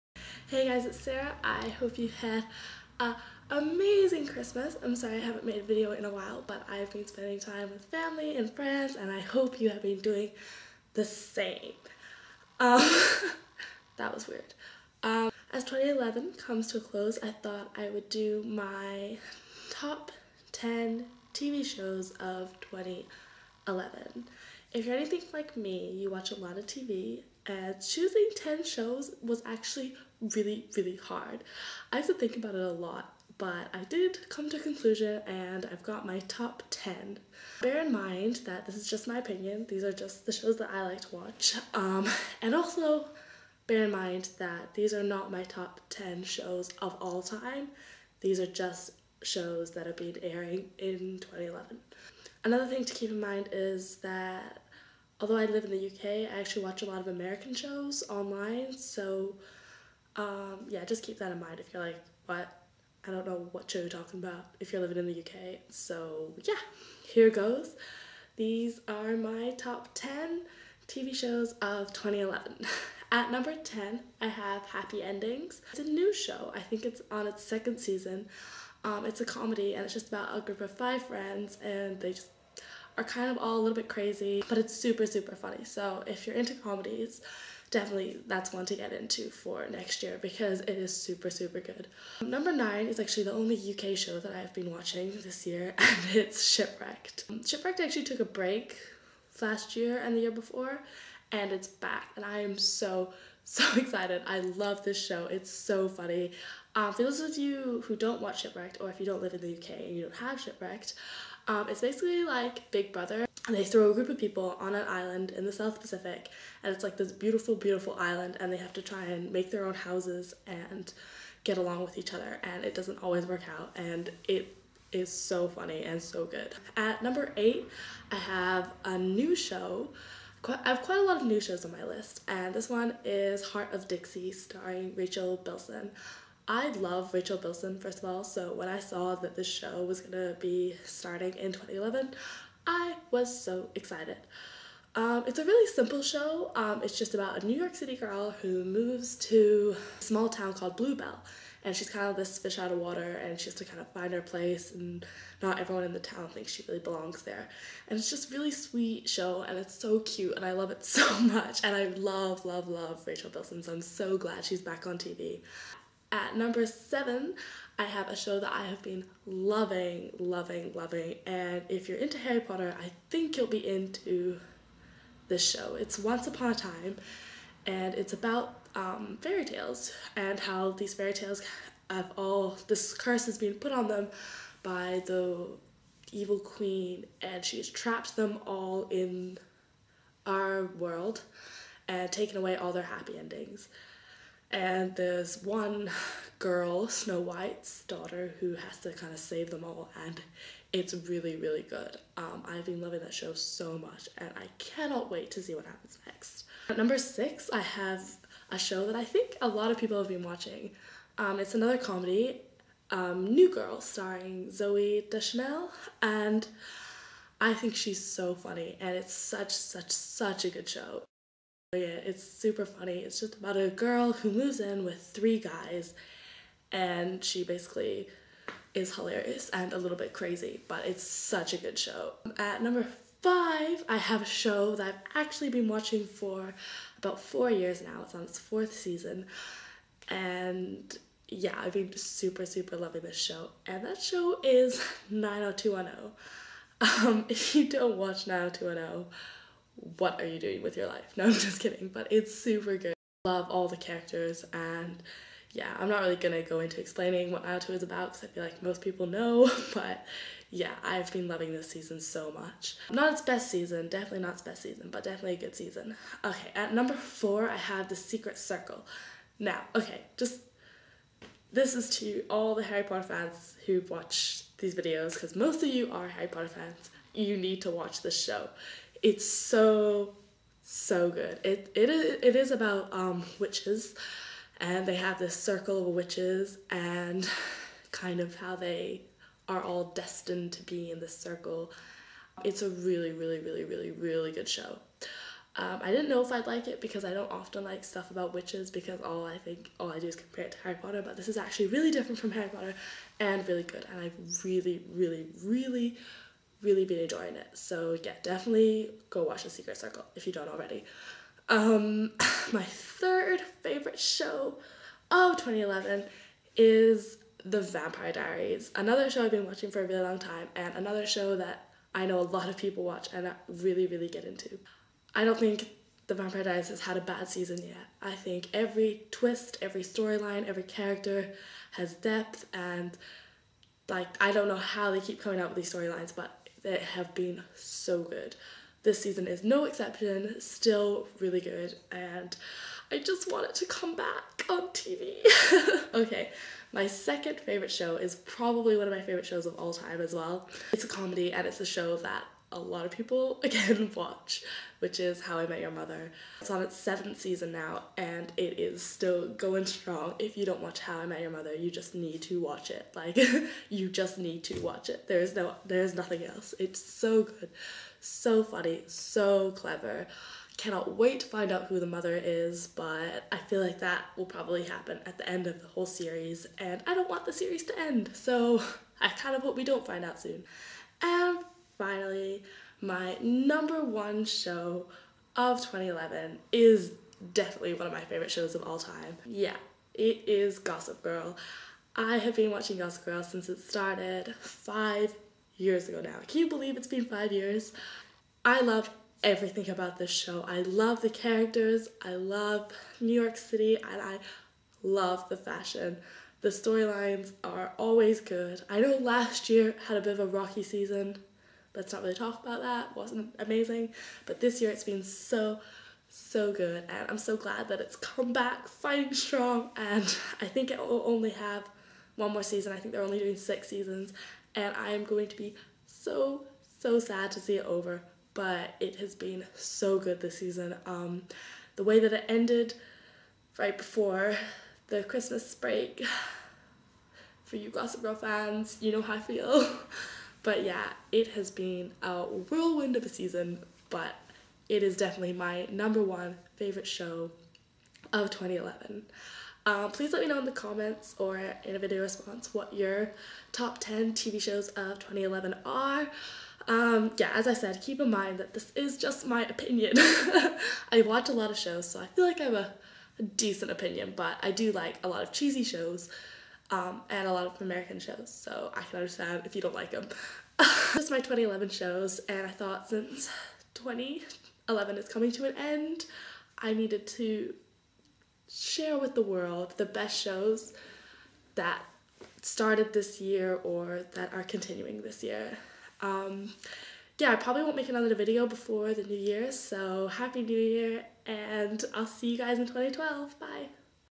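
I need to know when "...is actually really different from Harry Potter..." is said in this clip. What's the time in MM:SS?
05:01.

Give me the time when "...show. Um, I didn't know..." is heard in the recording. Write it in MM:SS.
04:54.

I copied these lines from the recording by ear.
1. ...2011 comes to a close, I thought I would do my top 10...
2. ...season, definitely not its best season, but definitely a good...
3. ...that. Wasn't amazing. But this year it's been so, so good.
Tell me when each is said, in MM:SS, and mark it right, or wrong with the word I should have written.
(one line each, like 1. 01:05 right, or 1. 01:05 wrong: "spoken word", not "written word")
1. 00:15 right
2. 04:23 right
3. 06:52 right.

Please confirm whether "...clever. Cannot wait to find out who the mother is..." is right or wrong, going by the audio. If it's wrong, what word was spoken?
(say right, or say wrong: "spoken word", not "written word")
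right.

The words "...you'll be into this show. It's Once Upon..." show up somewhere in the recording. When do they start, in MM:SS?
02:53.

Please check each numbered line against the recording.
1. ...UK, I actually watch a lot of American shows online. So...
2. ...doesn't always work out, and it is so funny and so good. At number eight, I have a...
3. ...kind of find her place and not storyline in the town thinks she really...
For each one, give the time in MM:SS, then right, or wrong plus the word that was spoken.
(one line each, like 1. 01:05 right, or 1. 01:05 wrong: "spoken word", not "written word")
1. 00:55 right
2. 02:02 right
3. 02:33 wrong: "everyone", not "storyline".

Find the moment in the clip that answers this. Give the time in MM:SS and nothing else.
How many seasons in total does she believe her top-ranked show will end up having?
07:03.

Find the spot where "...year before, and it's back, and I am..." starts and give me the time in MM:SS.
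01:40.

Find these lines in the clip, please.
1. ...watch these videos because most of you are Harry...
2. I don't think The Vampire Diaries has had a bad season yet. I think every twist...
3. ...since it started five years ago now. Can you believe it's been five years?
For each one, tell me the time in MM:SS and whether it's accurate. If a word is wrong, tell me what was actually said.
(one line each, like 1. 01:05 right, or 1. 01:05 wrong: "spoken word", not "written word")
1. 04:33 right
2. 05:25 right
3. 06:33 right.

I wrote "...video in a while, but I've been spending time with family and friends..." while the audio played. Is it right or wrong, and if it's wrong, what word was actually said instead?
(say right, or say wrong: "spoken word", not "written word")
right.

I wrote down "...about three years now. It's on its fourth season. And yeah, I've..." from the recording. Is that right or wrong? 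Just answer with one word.
wrong.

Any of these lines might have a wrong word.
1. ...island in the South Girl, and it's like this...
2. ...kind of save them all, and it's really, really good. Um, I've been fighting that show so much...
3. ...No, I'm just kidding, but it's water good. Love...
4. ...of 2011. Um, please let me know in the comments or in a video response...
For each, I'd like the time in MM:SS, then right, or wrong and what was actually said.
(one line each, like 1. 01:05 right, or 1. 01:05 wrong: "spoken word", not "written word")
1. 01:54 wrong: "Pacific", not "Girl"
2. 03:18 wrong: "loving", not "fighting"
3. 04:11 wrong: "super", not "water"
4. 07:28 right.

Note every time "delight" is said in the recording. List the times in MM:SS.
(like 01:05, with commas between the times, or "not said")
not said.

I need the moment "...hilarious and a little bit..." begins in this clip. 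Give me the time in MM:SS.
03:48.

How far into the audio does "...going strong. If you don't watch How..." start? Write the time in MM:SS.
05:59.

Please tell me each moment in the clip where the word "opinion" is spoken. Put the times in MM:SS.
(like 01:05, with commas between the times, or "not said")
00:39, 07:39, 07:43.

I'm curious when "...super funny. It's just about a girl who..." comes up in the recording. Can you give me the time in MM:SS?
03:42.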